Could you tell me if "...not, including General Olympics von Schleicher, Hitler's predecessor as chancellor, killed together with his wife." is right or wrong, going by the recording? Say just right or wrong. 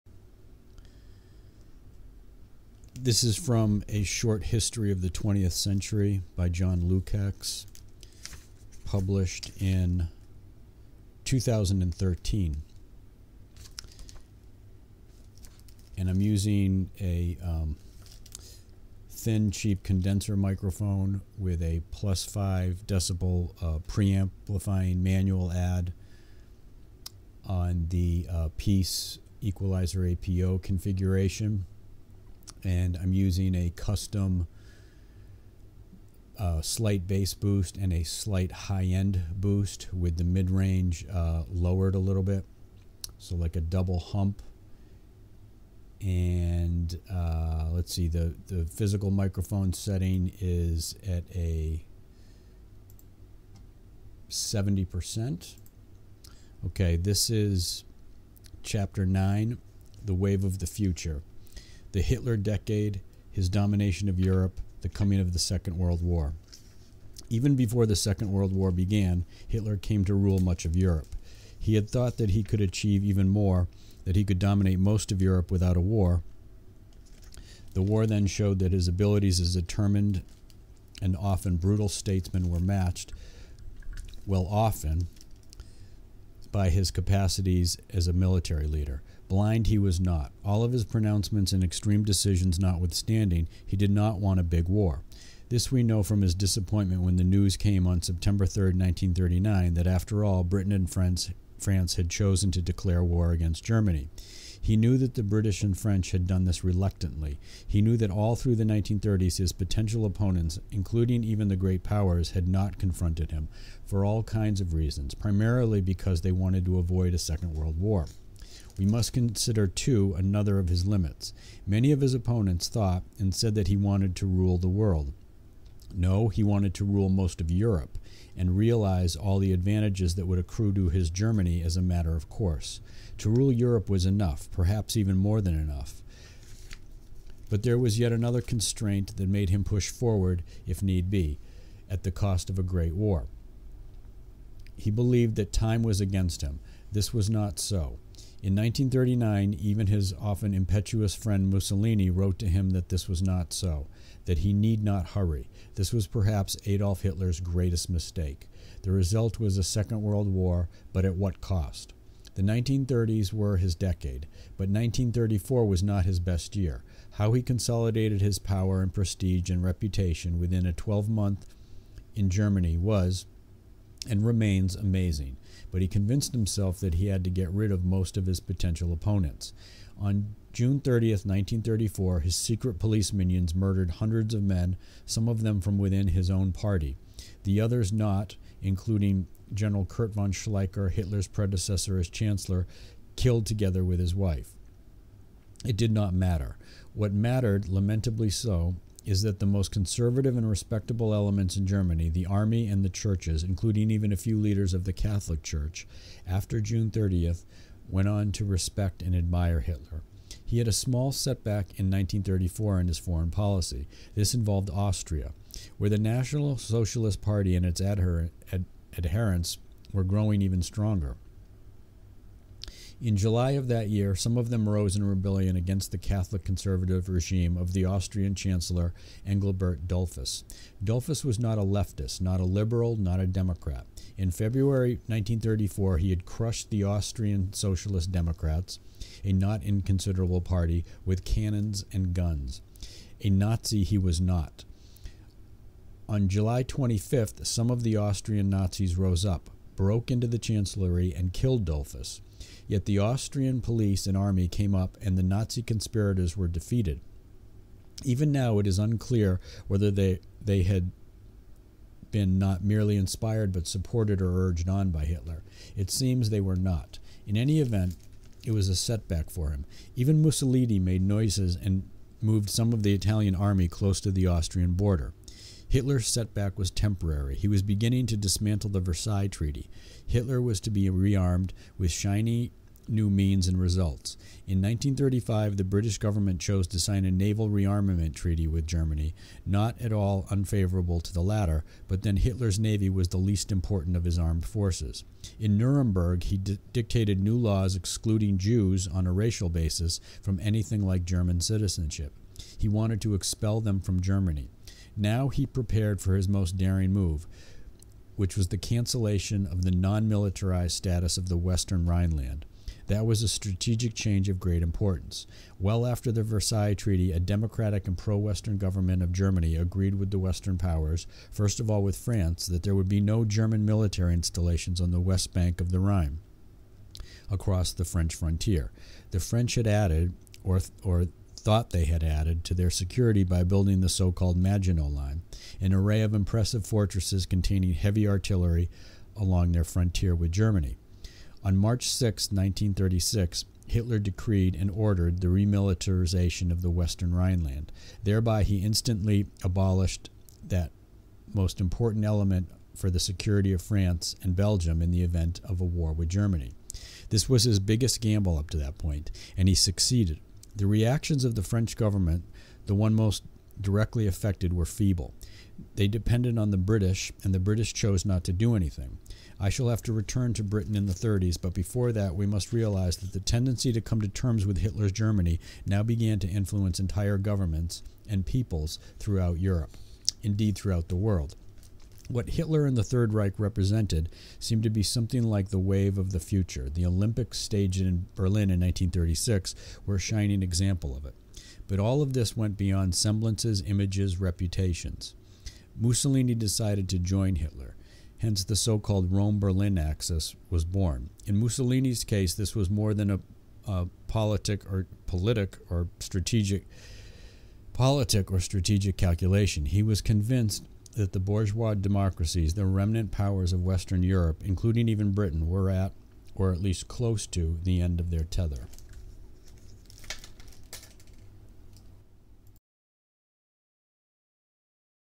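wrong.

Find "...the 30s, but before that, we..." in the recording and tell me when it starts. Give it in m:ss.
6:10.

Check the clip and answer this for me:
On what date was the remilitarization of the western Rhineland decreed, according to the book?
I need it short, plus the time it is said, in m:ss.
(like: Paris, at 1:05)
March 6, 1936, at 5:41.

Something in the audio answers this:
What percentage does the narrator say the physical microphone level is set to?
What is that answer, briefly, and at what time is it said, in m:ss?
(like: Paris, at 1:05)
70%, at 0:54.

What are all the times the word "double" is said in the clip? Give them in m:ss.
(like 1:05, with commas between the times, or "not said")
0:43.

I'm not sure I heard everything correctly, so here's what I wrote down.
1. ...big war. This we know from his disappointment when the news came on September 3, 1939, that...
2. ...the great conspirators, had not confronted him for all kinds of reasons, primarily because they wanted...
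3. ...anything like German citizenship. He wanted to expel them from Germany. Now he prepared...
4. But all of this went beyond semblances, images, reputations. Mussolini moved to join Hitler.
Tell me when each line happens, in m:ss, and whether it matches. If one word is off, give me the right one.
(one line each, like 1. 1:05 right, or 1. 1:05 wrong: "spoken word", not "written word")
1. 1:34 right
2. 1:51 wrong: "powers", not "conspirators"
3. 5:00 right
4. 6:31 wrong: "decided", not "moved".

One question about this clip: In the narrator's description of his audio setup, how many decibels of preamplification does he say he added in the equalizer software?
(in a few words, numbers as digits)
5.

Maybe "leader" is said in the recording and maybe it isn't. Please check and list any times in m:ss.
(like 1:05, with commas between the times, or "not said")
1:28, 3:24.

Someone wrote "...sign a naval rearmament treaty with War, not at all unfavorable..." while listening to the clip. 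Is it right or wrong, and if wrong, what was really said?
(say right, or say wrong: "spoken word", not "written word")
wrong: "Germany", not "War".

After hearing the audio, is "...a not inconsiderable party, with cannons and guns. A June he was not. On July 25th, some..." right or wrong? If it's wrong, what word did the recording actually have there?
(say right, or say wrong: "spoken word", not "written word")
wrong: "Nazi", not "June".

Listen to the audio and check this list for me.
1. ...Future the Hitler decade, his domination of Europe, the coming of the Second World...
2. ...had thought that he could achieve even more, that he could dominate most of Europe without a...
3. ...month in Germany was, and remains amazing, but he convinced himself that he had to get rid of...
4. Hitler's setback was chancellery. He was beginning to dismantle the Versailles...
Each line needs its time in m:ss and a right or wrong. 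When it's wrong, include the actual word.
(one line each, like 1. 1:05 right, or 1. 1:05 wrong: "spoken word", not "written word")
1. 1:00 right
2. 1:11 right
3. 2:51 right
4. 4:35 wrong: "temporary", not "chancellery".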